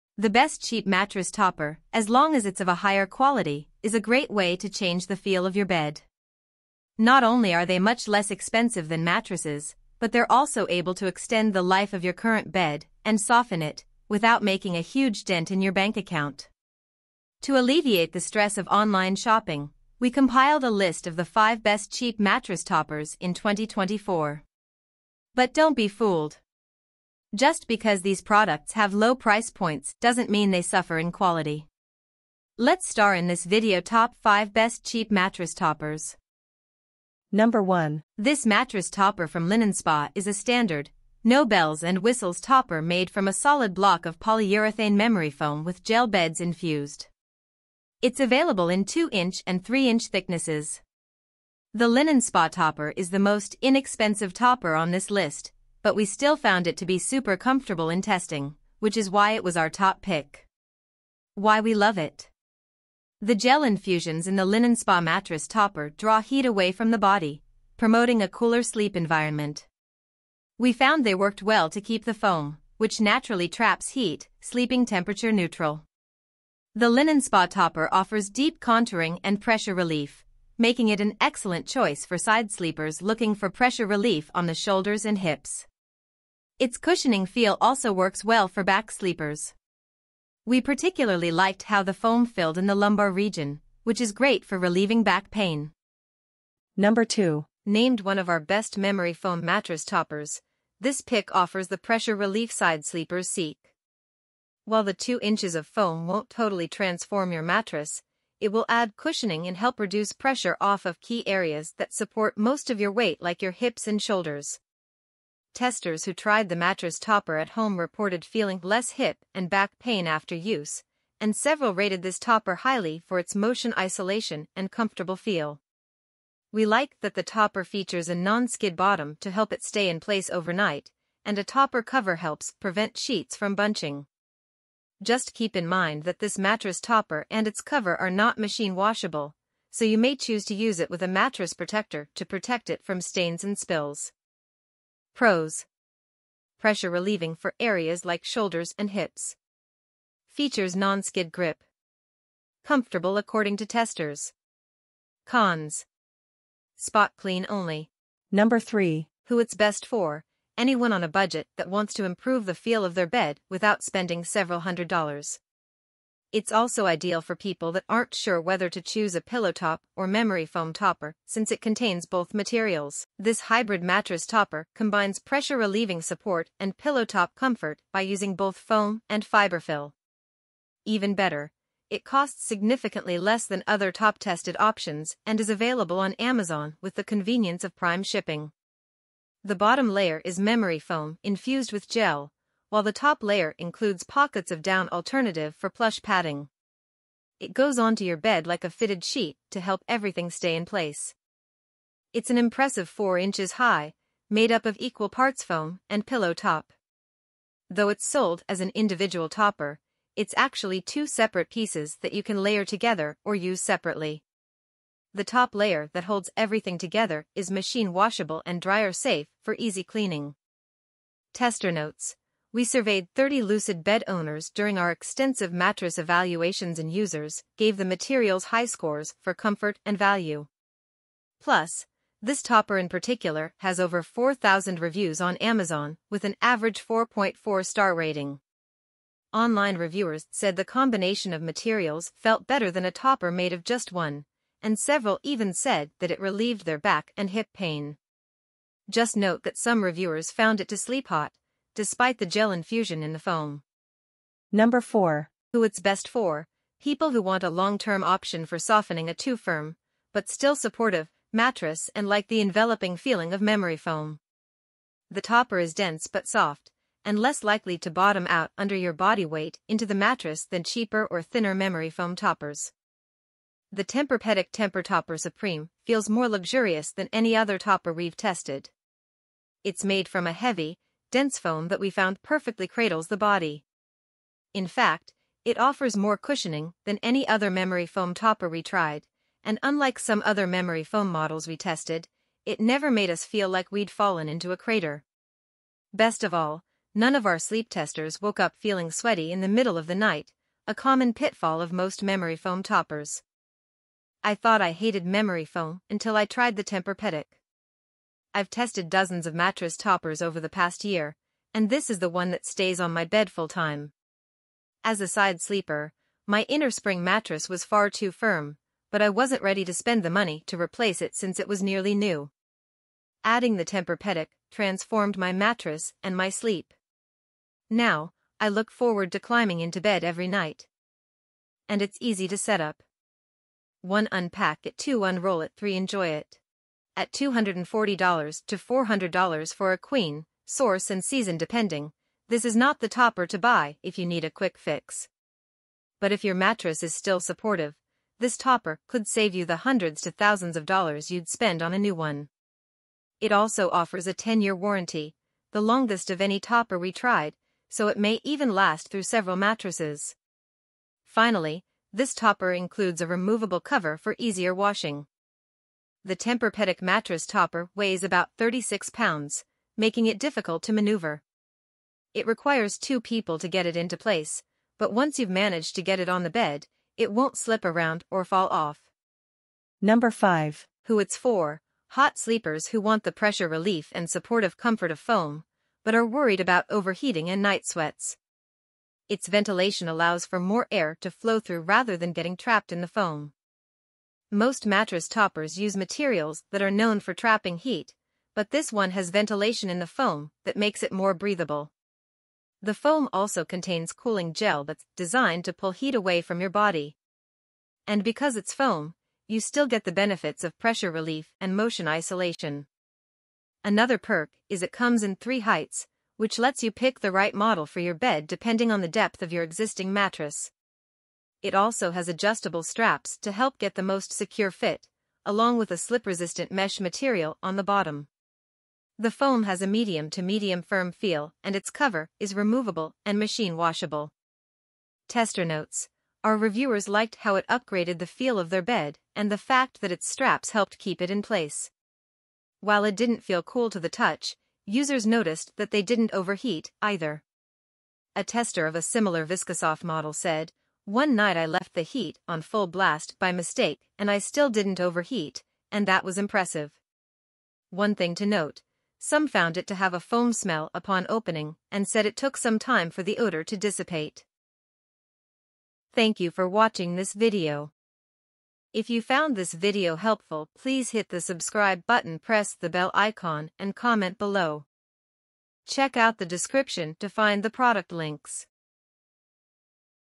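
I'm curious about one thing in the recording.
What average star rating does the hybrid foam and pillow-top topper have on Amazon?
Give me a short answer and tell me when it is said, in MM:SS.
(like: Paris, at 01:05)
4.4, at 03:56.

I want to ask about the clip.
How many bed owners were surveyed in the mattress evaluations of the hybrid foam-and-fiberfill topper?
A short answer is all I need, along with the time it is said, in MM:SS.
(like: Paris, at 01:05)
30, at 03:43.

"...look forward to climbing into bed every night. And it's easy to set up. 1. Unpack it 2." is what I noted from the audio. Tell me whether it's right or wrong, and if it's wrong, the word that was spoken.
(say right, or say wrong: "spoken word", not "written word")
right.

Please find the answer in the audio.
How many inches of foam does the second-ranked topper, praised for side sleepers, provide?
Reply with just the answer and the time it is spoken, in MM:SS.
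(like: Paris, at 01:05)
2, at 01:44.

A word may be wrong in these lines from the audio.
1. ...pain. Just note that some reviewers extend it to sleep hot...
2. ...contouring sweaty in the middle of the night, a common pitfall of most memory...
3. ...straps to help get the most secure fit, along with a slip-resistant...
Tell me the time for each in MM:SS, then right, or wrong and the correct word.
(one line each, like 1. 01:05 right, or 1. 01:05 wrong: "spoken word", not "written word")
1. 04:07 wrong: "found", not "extend"
2. 04:58 wrong: "feeling", not "contouring"
3. 07:02 right.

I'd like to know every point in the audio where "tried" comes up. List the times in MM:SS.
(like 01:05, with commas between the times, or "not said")
01:56, 04:48, 05:06, 05:56.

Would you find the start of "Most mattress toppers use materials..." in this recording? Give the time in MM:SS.
06:34.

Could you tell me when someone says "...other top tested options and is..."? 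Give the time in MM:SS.
03:03.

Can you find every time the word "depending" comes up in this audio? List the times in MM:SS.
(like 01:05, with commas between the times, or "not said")
05:41, 06:58.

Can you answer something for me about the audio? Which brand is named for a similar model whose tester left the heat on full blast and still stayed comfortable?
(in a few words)
Viscosoft.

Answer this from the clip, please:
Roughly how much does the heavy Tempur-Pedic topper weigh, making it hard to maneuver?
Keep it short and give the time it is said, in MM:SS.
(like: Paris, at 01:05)
36 pounds, at 06:08.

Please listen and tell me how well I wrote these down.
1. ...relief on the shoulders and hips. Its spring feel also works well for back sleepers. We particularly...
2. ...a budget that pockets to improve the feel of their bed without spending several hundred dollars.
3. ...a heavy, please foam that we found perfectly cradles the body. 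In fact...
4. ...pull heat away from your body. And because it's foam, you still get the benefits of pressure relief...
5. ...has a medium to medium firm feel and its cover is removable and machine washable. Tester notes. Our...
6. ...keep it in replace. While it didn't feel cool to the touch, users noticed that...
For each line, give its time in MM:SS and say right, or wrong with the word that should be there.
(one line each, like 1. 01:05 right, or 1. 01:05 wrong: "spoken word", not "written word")
1. 01:23 wrong: "cushioning", not "spring"
2. 02:41 wrong: "wants", not "pockets"
3. 04:40 wrong: "dense", not "please"
4. 06:45 right
5. 07:09 right
6. 07:20 wrong: "place", not "replace".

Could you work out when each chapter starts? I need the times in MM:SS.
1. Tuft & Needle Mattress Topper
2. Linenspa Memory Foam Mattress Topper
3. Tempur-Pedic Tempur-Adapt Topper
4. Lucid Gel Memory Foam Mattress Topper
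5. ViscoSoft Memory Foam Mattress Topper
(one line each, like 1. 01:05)
1. 01:36
2. 00:37
3. 04:14
4. 02:38
5. 06:19.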